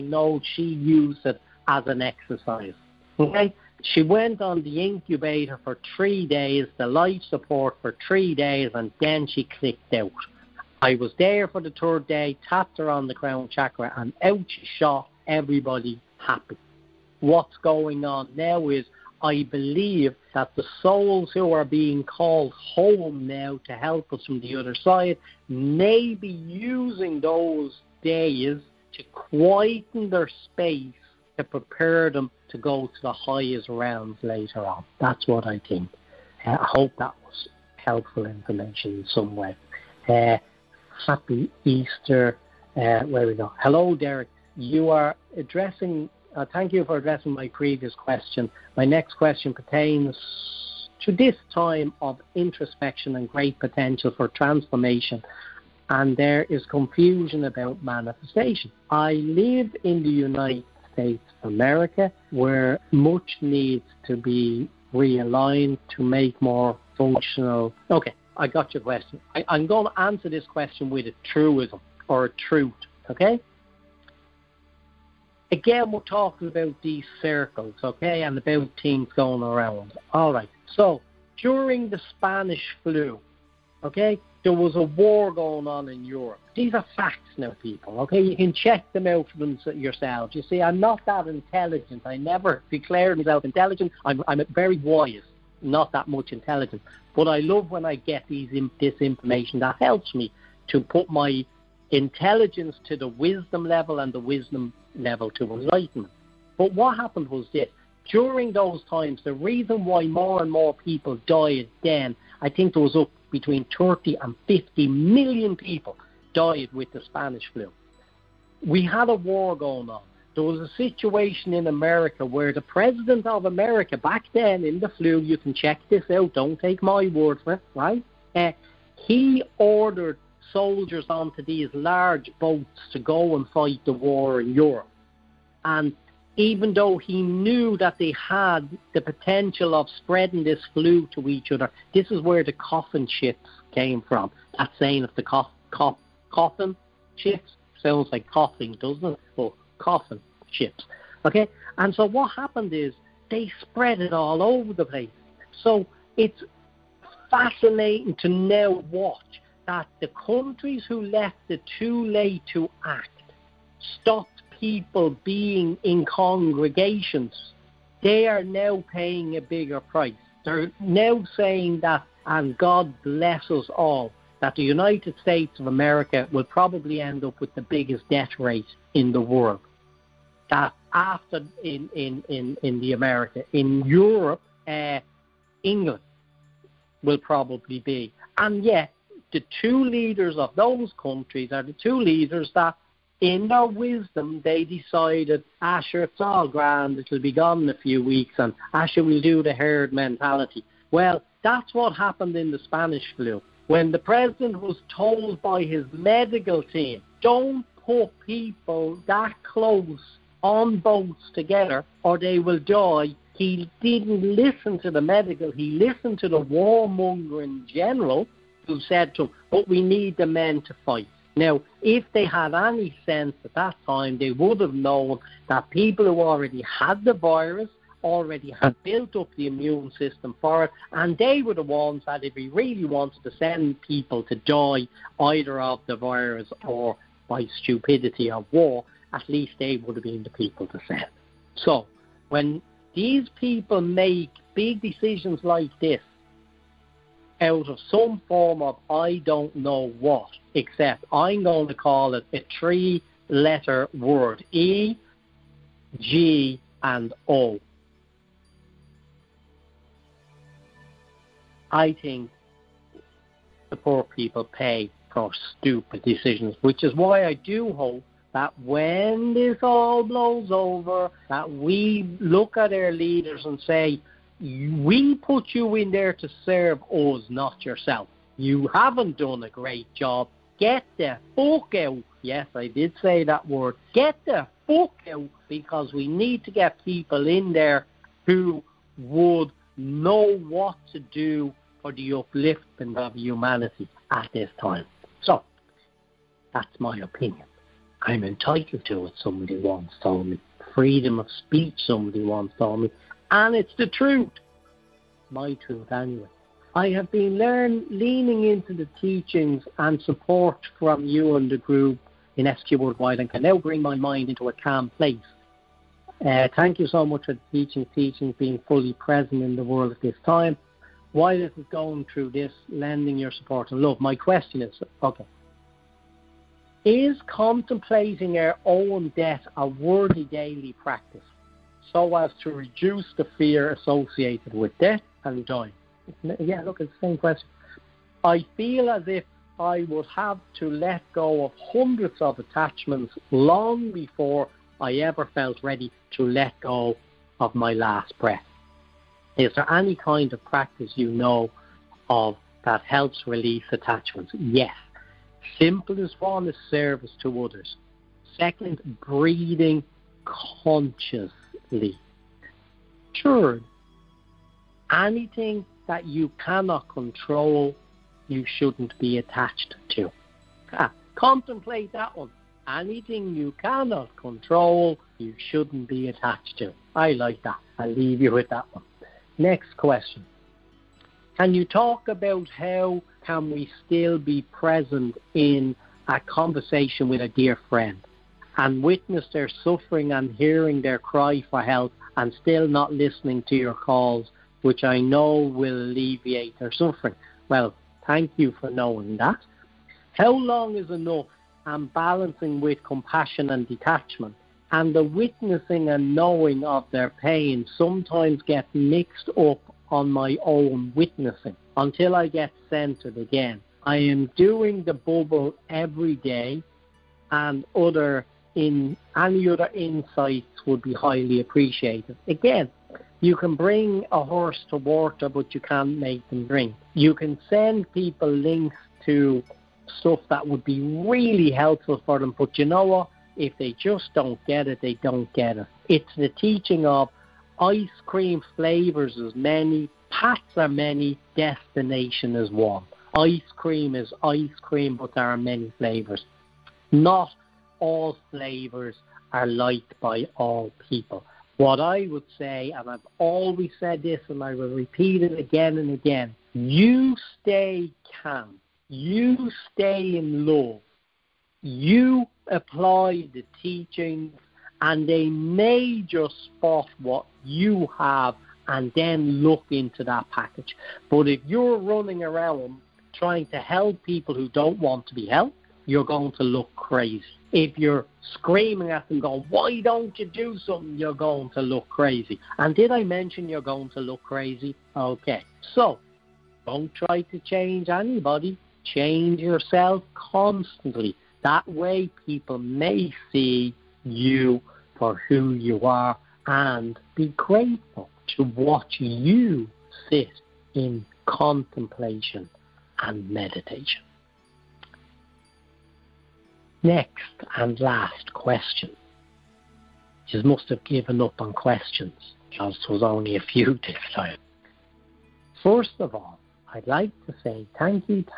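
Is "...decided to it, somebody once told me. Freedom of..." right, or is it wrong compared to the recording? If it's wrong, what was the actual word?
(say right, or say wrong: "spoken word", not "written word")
wrong: "entitled", not "decided".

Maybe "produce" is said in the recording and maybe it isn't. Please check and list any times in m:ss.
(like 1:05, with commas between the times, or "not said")
not said.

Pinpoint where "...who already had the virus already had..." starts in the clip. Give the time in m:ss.
3:46.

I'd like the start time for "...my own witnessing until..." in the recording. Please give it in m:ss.
6:50.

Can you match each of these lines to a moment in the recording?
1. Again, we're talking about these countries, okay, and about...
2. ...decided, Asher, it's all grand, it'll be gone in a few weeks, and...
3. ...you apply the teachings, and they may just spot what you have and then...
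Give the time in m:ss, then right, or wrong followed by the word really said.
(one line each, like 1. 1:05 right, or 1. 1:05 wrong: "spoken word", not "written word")
1. 1:15 wrong: "circles", not "countries"
2. 3:14 right
3. 7:41 right.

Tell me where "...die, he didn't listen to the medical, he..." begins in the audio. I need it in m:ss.
3:32.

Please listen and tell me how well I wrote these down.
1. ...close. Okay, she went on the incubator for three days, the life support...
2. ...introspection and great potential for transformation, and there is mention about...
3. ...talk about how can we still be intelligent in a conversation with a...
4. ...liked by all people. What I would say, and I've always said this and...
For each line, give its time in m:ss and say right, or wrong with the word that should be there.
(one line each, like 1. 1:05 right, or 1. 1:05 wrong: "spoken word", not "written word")
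1. 0:02 wrong: "exercise", not "close"
2. 0:52 wrong: "confusion", not "mention"
3. 6:21 wrong: "present", not "intelligent"
4. 7:29 right.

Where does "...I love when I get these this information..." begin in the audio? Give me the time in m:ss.
1:37.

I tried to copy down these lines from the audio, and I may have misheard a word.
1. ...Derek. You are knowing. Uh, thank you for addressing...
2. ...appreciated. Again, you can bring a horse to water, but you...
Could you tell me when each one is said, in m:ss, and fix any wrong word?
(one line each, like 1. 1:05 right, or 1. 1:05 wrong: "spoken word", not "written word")
1. 0:43 wrong: "addressing", not "knowing"
2. 7:01 right.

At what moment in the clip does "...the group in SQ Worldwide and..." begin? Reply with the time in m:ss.
5:11.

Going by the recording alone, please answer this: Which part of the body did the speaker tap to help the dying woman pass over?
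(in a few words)
Crown chakra.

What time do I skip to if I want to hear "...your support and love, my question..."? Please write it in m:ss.
5:23.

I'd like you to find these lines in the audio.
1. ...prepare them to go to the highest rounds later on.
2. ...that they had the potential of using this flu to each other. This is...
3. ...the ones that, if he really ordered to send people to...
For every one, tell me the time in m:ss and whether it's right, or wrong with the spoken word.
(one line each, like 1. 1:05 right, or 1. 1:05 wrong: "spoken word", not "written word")
1. 0:31 right
2. 2:17 wrong: "spreading", not "using"
3. 3:51 wrong: "wanted", not "ordered".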